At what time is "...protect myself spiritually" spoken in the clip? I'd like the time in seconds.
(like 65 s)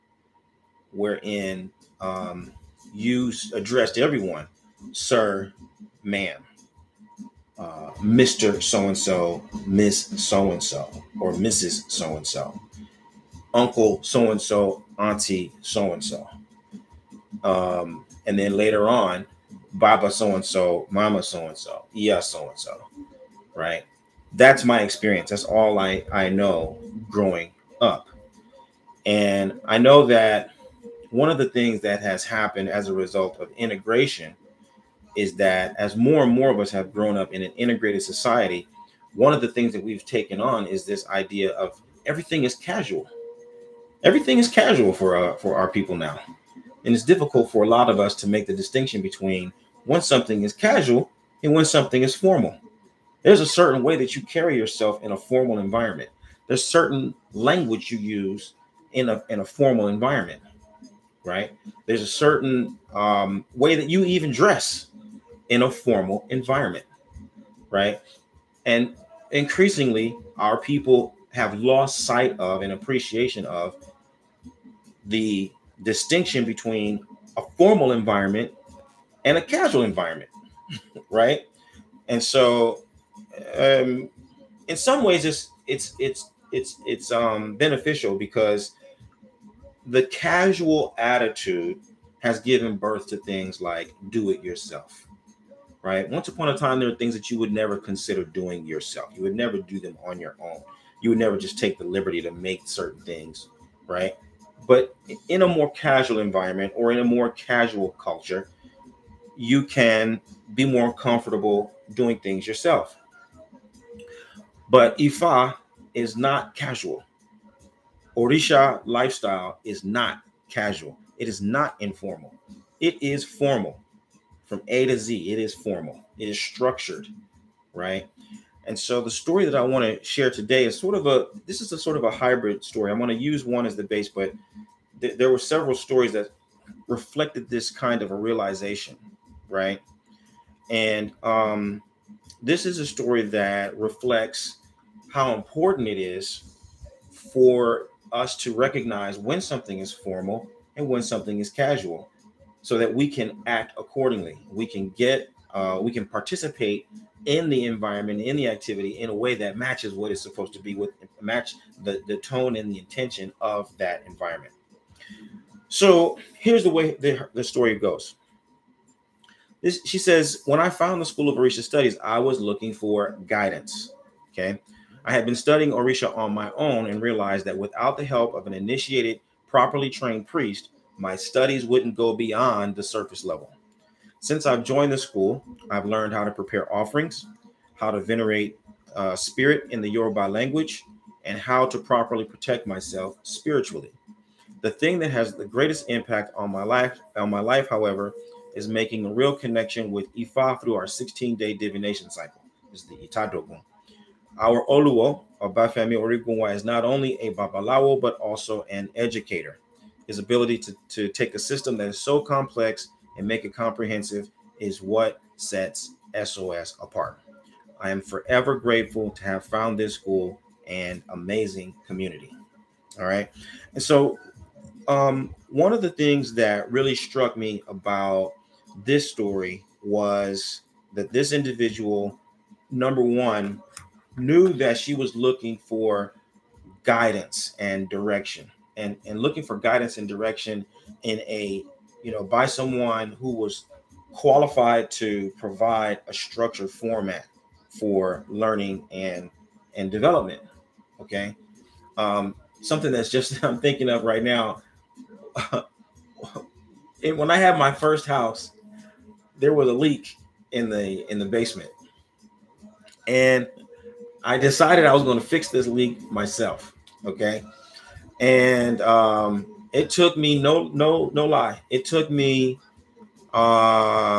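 192 s.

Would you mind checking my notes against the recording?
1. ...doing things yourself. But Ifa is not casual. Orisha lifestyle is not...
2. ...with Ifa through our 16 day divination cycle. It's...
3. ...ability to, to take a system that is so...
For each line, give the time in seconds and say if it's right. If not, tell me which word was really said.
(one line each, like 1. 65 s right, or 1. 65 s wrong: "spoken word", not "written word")
1. 111 s right
2. 199 s right
3. 210 s right.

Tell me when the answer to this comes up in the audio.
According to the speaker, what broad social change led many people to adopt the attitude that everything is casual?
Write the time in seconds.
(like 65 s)
33 s.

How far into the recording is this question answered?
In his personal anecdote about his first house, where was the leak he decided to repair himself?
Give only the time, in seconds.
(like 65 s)
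261 s.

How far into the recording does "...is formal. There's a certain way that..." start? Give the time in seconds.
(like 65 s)
52 s.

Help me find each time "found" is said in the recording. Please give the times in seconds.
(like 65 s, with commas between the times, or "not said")
170 s, 219 s.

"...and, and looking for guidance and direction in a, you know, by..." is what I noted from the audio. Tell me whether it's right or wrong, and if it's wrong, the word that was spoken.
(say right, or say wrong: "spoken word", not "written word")
right.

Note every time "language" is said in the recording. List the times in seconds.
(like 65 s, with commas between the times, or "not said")
57 s, 190 s.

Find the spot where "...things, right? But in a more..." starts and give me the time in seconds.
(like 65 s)
103 s.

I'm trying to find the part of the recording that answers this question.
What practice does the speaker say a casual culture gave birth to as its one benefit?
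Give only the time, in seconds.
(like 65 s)
94 s.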